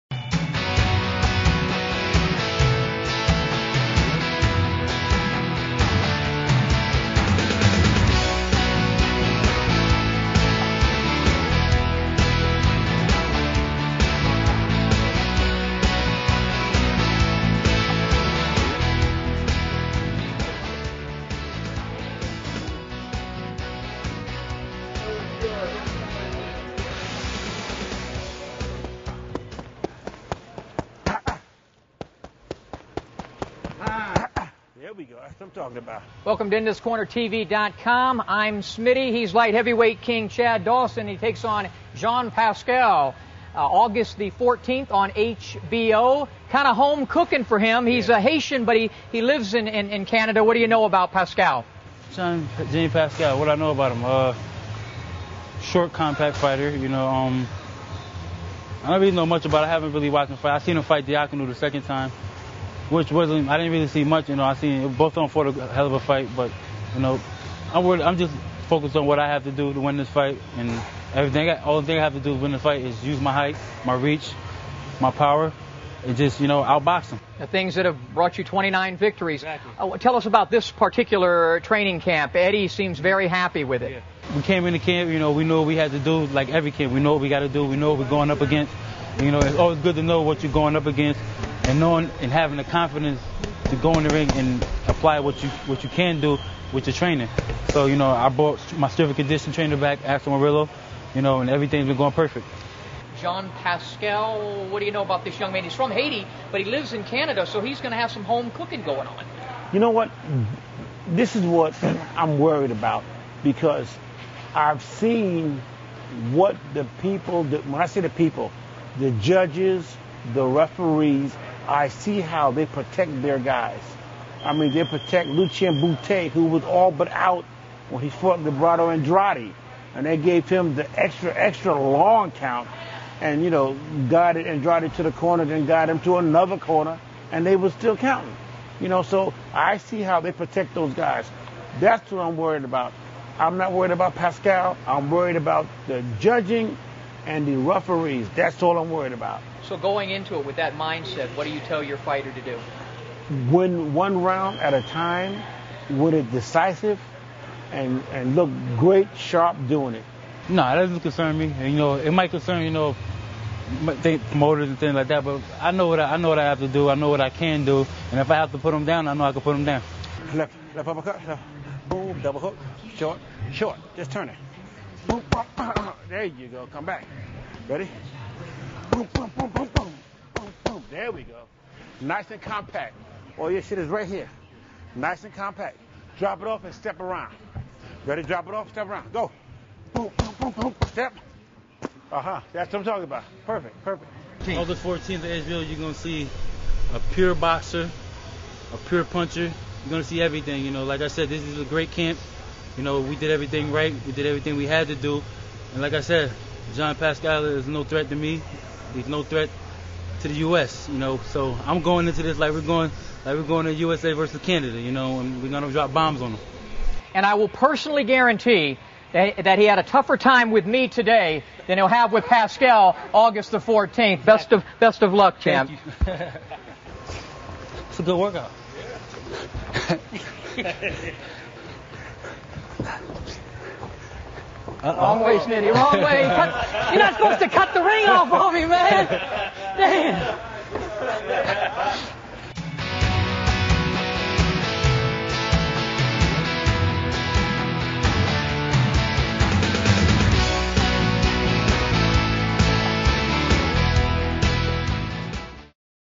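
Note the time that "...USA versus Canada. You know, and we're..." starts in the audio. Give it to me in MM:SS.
03:33.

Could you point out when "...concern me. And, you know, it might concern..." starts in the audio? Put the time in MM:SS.
02:40.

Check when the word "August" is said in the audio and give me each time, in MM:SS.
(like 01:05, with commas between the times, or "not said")
00:43, 03:14, 03:43.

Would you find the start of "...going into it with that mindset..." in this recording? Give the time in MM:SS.
02:29.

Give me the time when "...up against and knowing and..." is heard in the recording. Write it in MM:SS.
01:30.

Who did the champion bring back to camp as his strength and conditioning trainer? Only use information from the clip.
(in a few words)
Axel Murillo.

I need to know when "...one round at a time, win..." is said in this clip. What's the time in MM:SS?
02:33.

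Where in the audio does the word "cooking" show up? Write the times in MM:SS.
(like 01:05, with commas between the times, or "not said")
00:47, 01:48.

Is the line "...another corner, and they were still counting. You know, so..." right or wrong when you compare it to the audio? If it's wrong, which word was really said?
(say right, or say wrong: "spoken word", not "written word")
right.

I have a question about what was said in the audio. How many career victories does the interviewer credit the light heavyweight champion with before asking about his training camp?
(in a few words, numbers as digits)
29.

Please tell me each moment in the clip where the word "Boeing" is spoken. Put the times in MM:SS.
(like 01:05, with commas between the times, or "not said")
not said.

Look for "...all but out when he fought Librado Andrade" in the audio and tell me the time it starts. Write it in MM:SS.
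02:06.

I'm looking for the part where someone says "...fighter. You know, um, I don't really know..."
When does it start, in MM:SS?
00:56.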